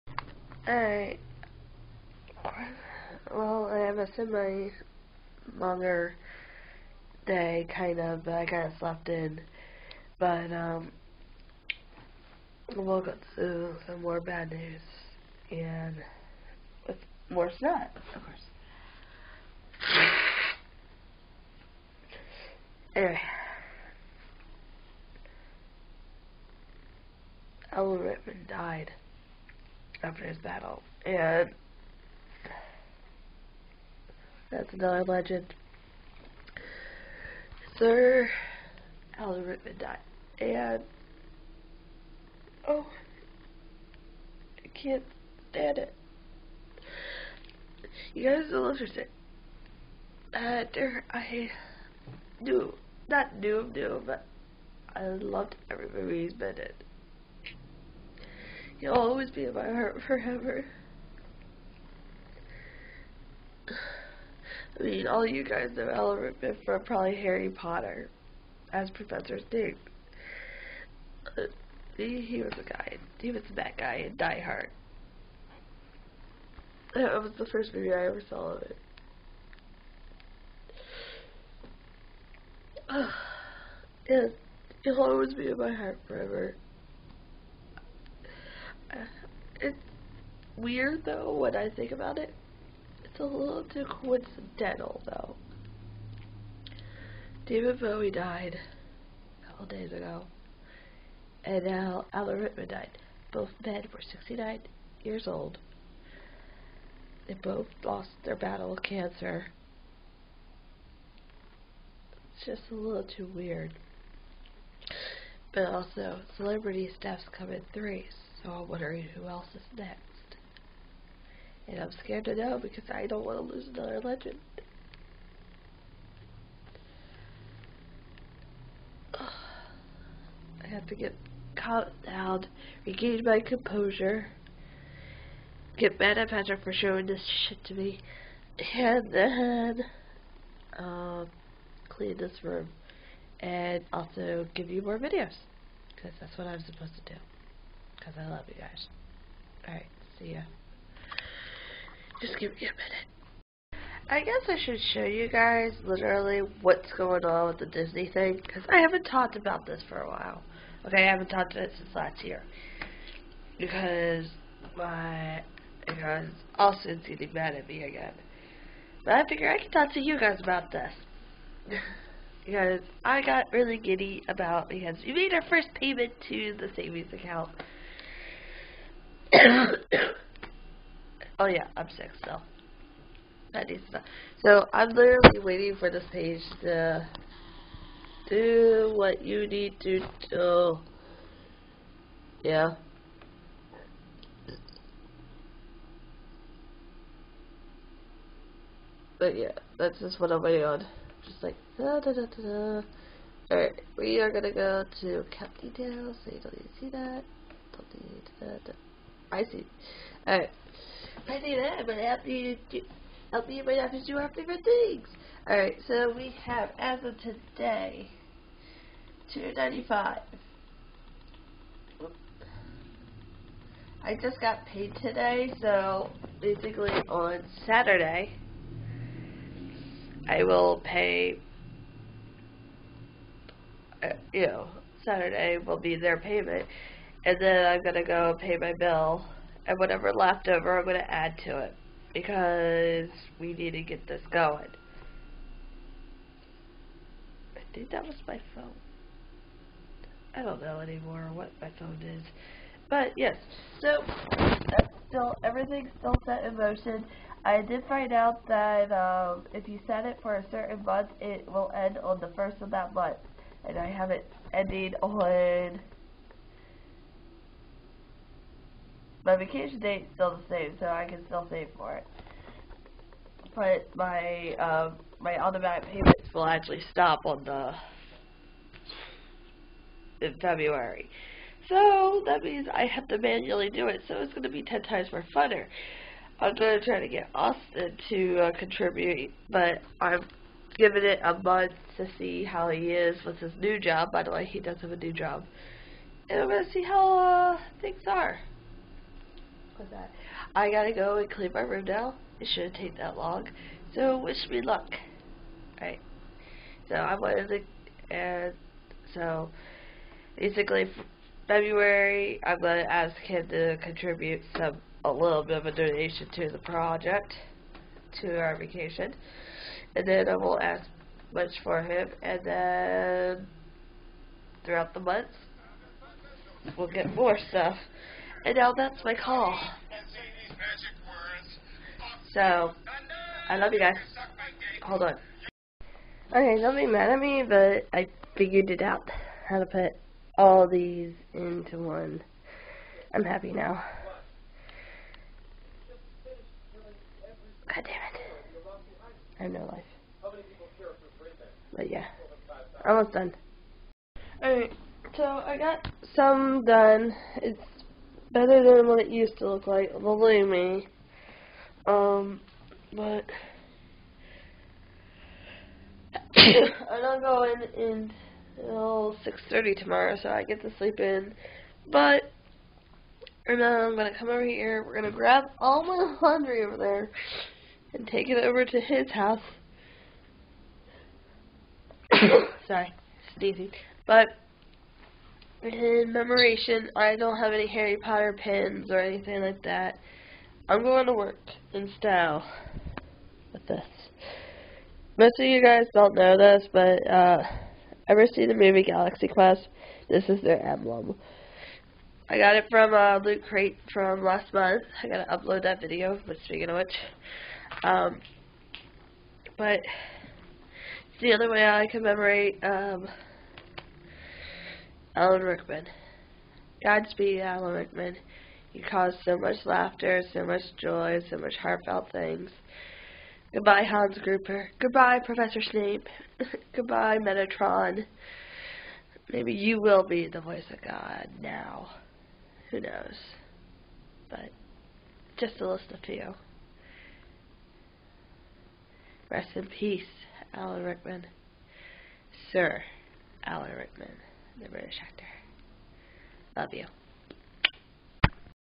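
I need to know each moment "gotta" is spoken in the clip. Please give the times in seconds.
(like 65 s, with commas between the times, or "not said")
300 s, 405 s.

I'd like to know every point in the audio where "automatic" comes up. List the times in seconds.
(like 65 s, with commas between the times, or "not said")
275 s.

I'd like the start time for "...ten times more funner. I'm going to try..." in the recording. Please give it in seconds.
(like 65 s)
284 s.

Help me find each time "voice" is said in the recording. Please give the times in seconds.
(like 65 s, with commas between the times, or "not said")
430 s.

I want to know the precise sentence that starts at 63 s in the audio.
I mean, all you guys know Element from probably Harry Potter as Professor Snape.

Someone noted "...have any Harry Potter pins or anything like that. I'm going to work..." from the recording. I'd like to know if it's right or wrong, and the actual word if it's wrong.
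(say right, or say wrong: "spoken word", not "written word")
right.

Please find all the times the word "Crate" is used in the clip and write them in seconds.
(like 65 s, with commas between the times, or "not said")
403 s.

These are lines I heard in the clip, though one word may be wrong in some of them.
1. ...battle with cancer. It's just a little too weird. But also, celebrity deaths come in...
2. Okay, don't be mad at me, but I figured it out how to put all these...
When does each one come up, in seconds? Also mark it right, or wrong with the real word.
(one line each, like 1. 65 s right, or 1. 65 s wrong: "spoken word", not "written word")
1. 108 s right
2. 336 s right.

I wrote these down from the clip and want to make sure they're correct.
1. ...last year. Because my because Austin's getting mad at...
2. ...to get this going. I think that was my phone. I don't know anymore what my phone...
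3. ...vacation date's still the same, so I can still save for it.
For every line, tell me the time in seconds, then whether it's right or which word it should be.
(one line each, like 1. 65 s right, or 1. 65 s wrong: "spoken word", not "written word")
1. 161 s right
2. 243 s right
3. 269 s right.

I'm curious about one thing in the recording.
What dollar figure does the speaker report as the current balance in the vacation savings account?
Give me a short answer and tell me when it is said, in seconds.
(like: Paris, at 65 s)
295, at 219 s.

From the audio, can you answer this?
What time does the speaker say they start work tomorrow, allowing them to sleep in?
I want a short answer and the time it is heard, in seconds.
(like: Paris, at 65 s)
6:30, at 369 s.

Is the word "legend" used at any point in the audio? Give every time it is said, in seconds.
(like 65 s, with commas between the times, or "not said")
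35 s, 124 s.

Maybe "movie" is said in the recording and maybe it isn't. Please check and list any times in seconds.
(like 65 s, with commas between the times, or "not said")
55 s, 77 s, 398 s.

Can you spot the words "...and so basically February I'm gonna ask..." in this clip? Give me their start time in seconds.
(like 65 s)
308 s.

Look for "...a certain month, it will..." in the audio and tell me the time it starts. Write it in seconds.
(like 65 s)
260 s.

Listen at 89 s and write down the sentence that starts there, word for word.
It's weird though when I think about it.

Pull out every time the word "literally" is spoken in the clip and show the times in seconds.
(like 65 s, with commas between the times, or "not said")
155 s, 184 s.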